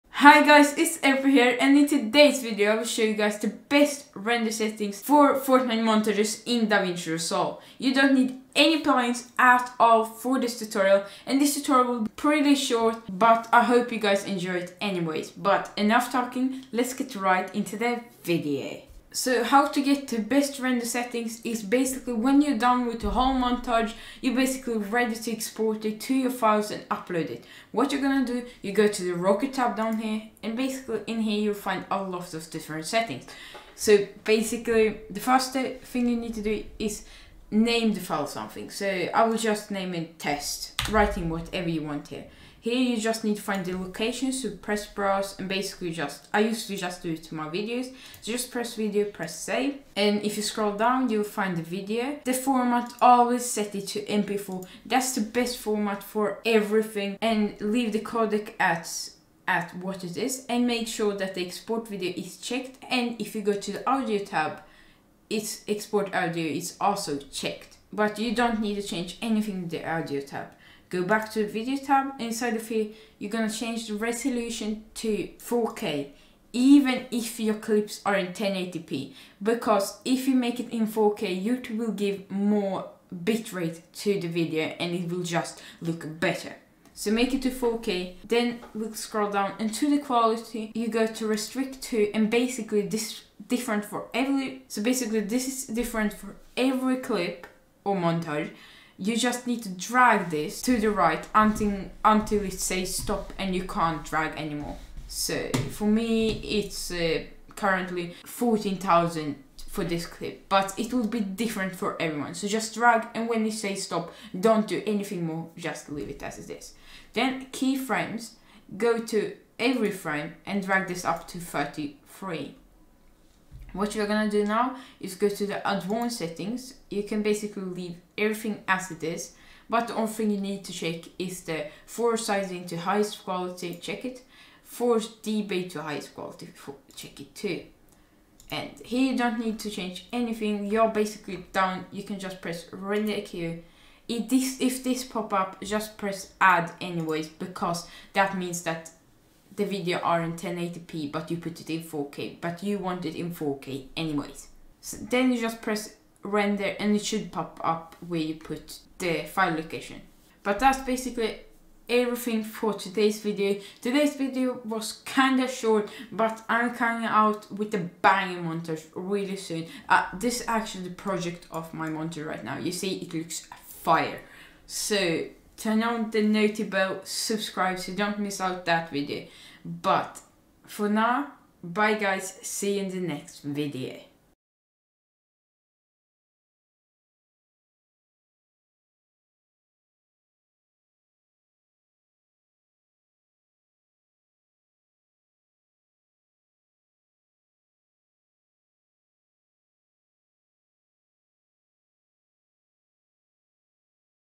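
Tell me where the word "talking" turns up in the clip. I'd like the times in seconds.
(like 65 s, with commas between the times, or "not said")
16 s.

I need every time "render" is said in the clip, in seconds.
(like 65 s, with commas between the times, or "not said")
4 s, 20 s, 142 s, 156 s.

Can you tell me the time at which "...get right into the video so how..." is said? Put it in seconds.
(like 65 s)
16 s.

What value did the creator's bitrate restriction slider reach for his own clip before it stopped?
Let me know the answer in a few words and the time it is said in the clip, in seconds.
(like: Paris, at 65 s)
14,000, at 108 s.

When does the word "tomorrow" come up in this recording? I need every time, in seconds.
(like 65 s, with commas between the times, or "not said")
not said.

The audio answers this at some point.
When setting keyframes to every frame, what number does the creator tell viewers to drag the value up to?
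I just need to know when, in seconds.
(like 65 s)
121 s.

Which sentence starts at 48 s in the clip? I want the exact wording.
So just press video, press save.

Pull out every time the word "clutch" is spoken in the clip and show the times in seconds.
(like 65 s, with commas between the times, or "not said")
not said.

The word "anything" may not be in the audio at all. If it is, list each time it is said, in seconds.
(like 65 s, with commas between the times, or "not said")
69 s, 114 s, 140 s.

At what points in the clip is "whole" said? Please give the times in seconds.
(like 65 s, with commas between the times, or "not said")
23 s.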